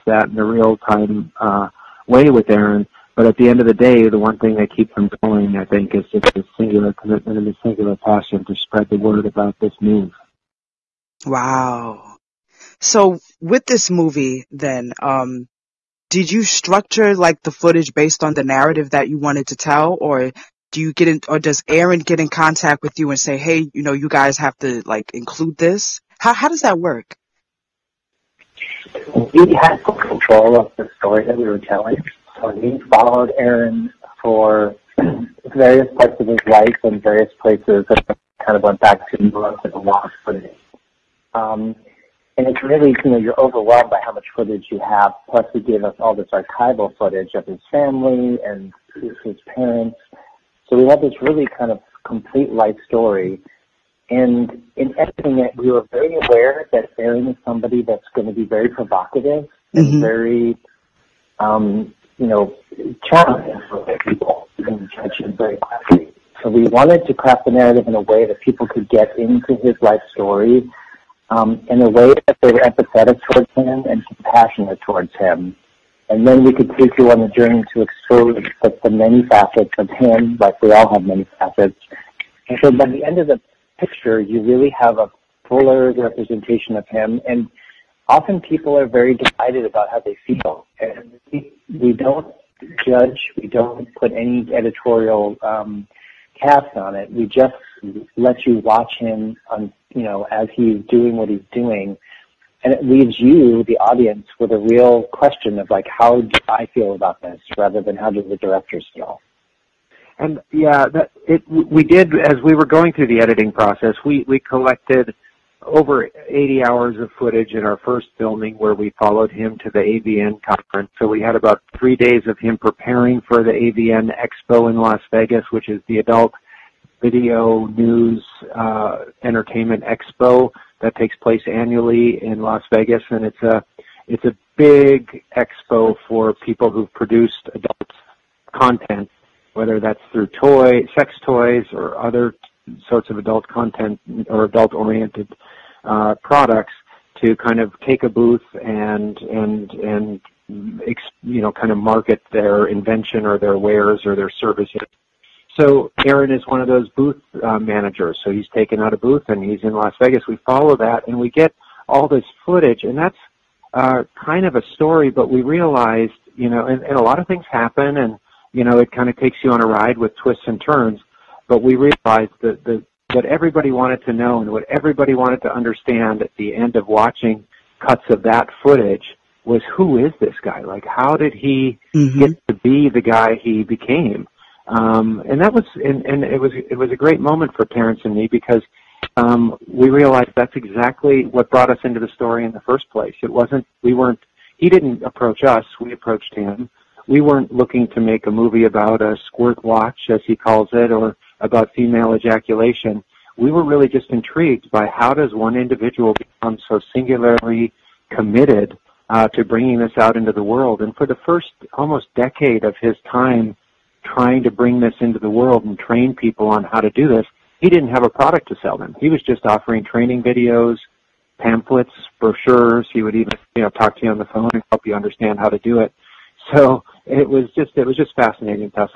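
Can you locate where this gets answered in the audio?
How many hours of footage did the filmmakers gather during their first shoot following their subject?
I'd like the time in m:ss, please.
1:55.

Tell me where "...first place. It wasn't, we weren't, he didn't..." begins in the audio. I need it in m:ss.
3:12.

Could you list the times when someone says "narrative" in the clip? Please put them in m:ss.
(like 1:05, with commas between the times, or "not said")
0:18, 1:07.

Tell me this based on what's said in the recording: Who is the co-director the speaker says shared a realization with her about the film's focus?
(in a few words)
Terence.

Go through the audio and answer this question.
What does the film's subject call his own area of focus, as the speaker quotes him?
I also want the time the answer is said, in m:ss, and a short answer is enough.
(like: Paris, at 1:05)
squirt watch, at 3:19.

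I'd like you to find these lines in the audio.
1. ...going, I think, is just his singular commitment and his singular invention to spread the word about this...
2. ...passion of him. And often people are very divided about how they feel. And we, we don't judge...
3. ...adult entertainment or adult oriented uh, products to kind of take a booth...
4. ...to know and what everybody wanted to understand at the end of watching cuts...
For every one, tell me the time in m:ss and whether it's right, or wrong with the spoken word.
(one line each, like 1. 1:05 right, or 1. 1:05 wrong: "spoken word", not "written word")
1. 0:05 wrong: "passion", not "invention"
2. 1:25 wrong: "representation", not "passion"
3. 2:23 wrong: "content", not "entertainment"
4. 2:54 right.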